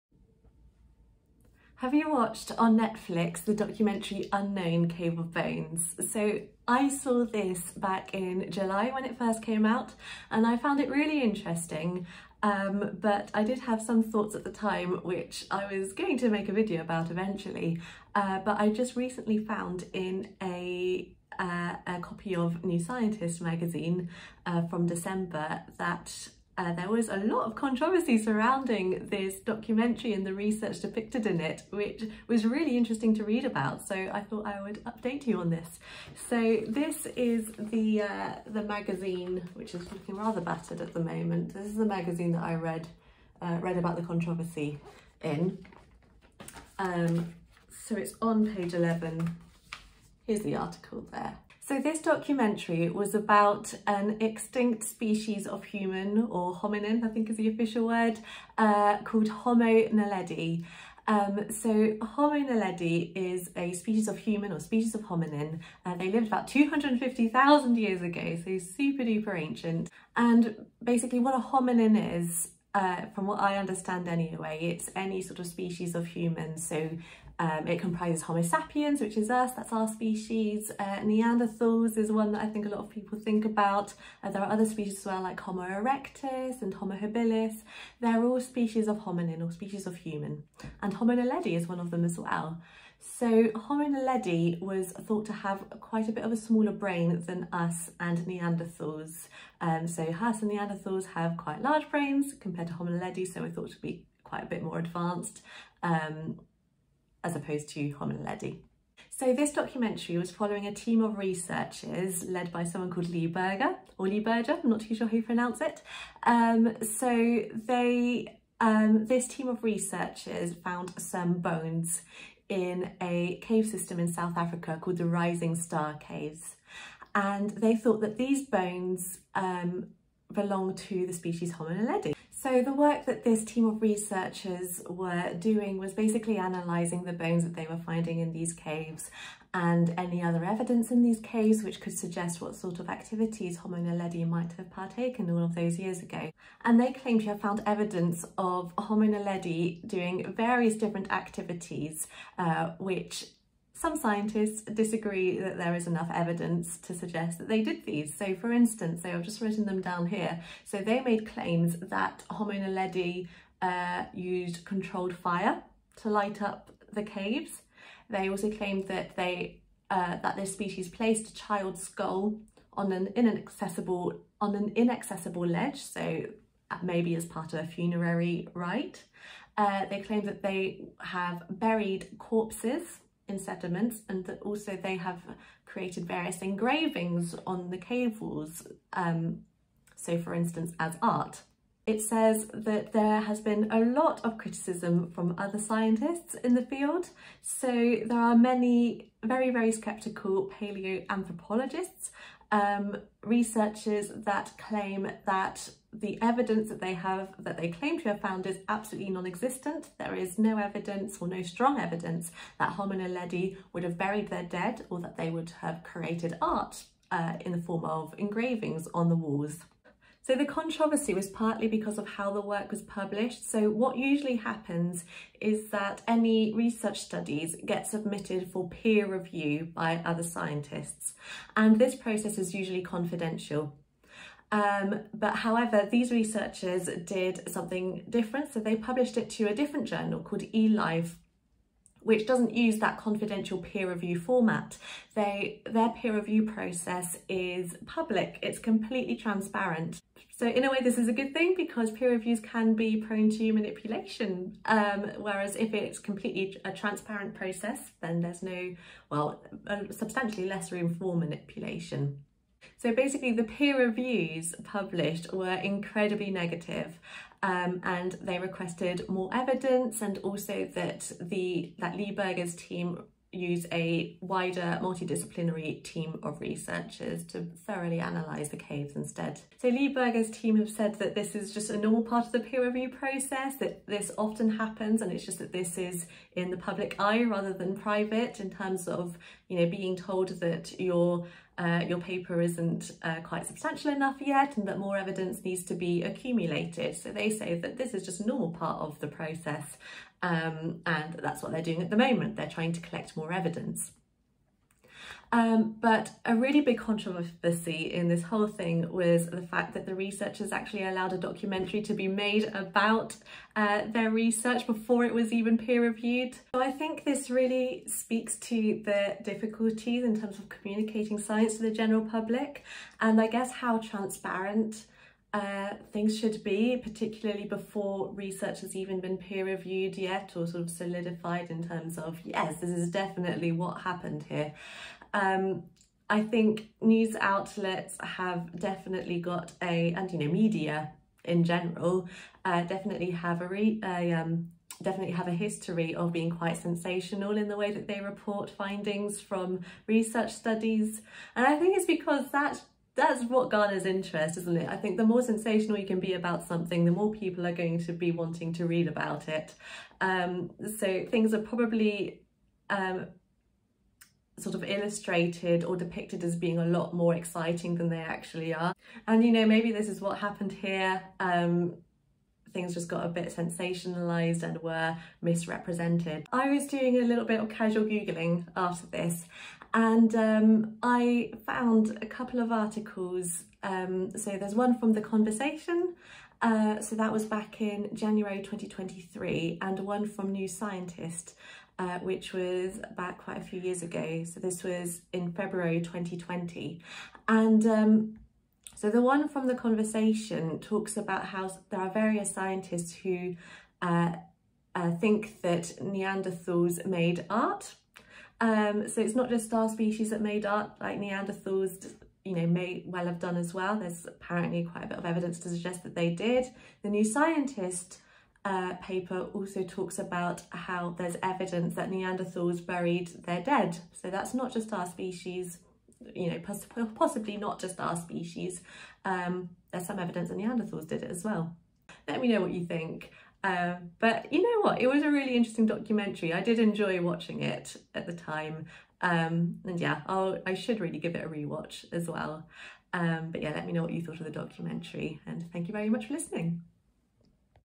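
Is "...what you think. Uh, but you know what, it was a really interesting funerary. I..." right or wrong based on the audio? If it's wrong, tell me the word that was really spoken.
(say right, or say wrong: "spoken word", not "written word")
wrong: "documentary", not "funerary".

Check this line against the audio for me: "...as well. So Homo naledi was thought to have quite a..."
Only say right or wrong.
right.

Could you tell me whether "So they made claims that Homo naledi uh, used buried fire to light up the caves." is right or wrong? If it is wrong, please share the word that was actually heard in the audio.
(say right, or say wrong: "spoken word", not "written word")
wrong: "controlled", not "buried".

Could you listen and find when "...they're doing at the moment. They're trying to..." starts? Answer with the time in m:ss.
5:01.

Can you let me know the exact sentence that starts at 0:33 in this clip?
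So I thought I would update you on this.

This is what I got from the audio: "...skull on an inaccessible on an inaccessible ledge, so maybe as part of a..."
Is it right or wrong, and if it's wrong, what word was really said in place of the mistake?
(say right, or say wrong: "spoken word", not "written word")
right.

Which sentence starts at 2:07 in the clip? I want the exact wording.
And they thought that these bones um, belong to the species Homo naledi.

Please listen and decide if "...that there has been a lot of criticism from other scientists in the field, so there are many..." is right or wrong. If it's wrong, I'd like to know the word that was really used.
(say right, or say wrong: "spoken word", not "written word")
right.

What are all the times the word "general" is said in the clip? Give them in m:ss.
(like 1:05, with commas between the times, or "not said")
5:21, 5:41.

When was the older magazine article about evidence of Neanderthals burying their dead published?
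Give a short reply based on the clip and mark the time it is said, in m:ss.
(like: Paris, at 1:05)
February 2020, at 6:35.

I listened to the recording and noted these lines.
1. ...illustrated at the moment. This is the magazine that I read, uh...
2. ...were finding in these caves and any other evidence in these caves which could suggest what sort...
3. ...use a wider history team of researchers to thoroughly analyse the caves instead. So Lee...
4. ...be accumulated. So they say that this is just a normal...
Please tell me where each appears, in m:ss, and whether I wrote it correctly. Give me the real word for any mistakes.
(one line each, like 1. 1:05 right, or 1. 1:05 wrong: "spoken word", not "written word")
1. 0:40 wrong: "battered", not "illustrated"
2. 2:17 right
3. 4:33 wrong: "multidisciplinary", not "history"
4. 4:55 right.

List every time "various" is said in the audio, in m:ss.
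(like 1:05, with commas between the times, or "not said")
2:30, 3:06, 6:41.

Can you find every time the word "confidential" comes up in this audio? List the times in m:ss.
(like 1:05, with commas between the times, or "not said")
3:52, 4:02.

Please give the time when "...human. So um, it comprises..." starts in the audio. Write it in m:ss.
1:16.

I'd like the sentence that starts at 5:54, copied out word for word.
I think the more sensational you can be about something, the more people are going to be wanting to read about it.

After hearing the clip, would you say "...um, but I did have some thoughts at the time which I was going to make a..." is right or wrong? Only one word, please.
right.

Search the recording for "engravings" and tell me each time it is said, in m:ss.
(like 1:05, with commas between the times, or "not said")
3:06, 3:38.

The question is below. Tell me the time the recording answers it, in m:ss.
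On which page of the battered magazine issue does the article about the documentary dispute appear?
0:48.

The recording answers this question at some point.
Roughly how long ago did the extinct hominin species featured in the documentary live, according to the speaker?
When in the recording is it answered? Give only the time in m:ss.
1:06.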